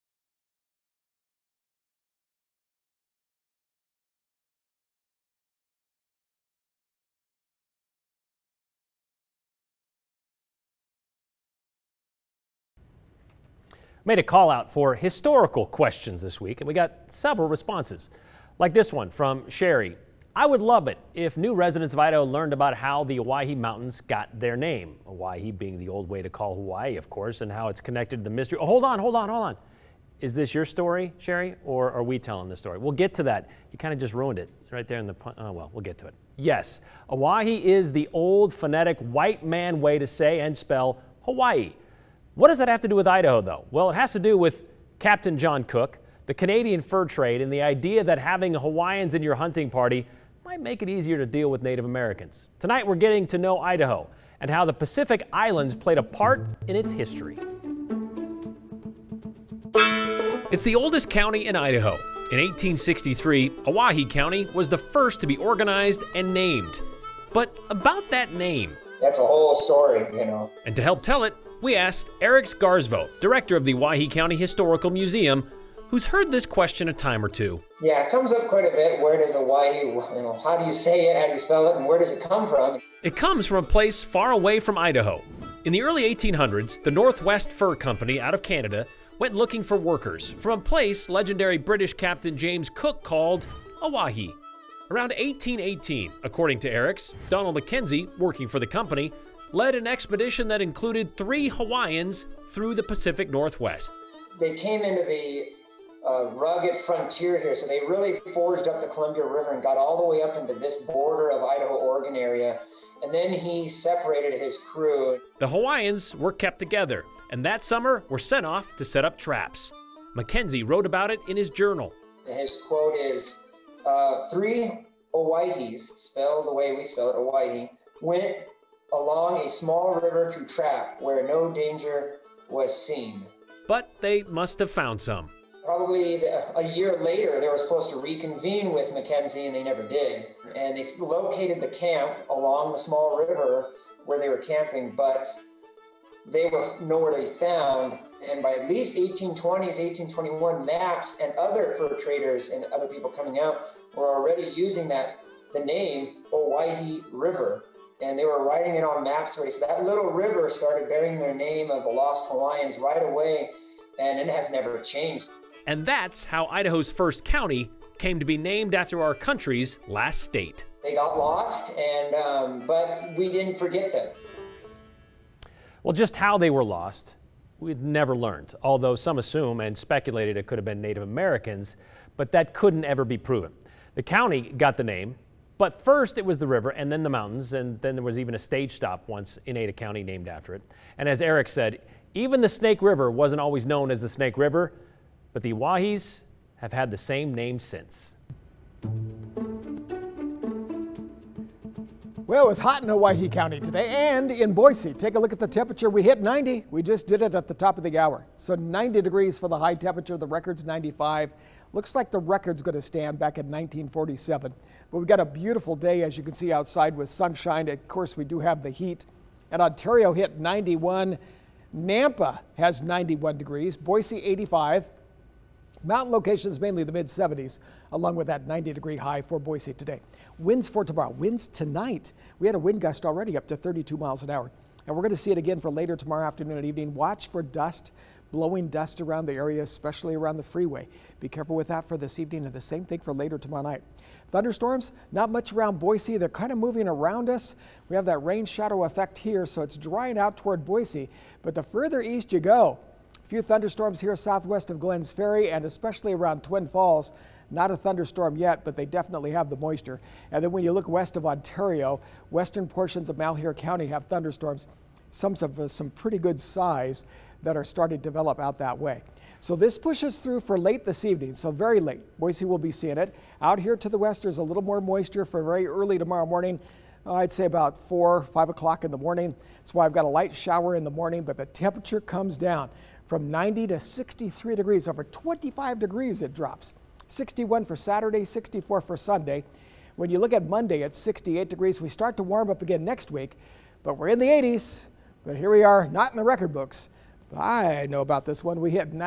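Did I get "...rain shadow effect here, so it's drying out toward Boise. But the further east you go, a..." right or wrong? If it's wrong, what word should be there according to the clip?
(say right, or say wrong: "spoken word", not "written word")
right.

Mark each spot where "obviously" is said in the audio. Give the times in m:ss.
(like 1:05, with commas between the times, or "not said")
not said.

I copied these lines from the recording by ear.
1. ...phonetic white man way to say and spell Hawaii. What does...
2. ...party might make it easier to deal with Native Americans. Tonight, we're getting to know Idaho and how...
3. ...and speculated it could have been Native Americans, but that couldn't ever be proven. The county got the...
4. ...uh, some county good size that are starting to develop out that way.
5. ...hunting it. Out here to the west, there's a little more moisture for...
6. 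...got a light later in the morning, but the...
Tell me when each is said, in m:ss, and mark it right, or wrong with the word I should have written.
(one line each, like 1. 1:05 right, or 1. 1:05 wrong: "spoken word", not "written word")
1. 0:38 right
2. 0:49 right
3. 2:59 right
4. 4:25 wrong: "pretty", not "county"
5. 4:32 wrong: "seeing", not "hunting"
6. 4:39 wrong: "shower", not "later".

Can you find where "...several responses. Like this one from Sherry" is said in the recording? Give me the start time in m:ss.
0:17.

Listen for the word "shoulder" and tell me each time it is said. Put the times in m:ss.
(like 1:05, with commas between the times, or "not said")
not said.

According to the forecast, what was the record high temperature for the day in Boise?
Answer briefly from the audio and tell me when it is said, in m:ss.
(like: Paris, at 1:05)
95, at 3:30.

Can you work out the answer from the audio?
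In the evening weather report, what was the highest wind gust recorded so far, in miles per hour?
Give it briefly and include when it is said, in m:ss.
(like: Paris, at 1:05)
32, at 3:53.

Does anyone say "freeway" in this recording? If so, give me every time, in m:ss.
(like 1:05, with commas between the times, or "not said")
4:00.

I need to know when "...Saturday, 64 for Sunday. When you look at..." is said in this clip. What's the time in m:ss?
4:47.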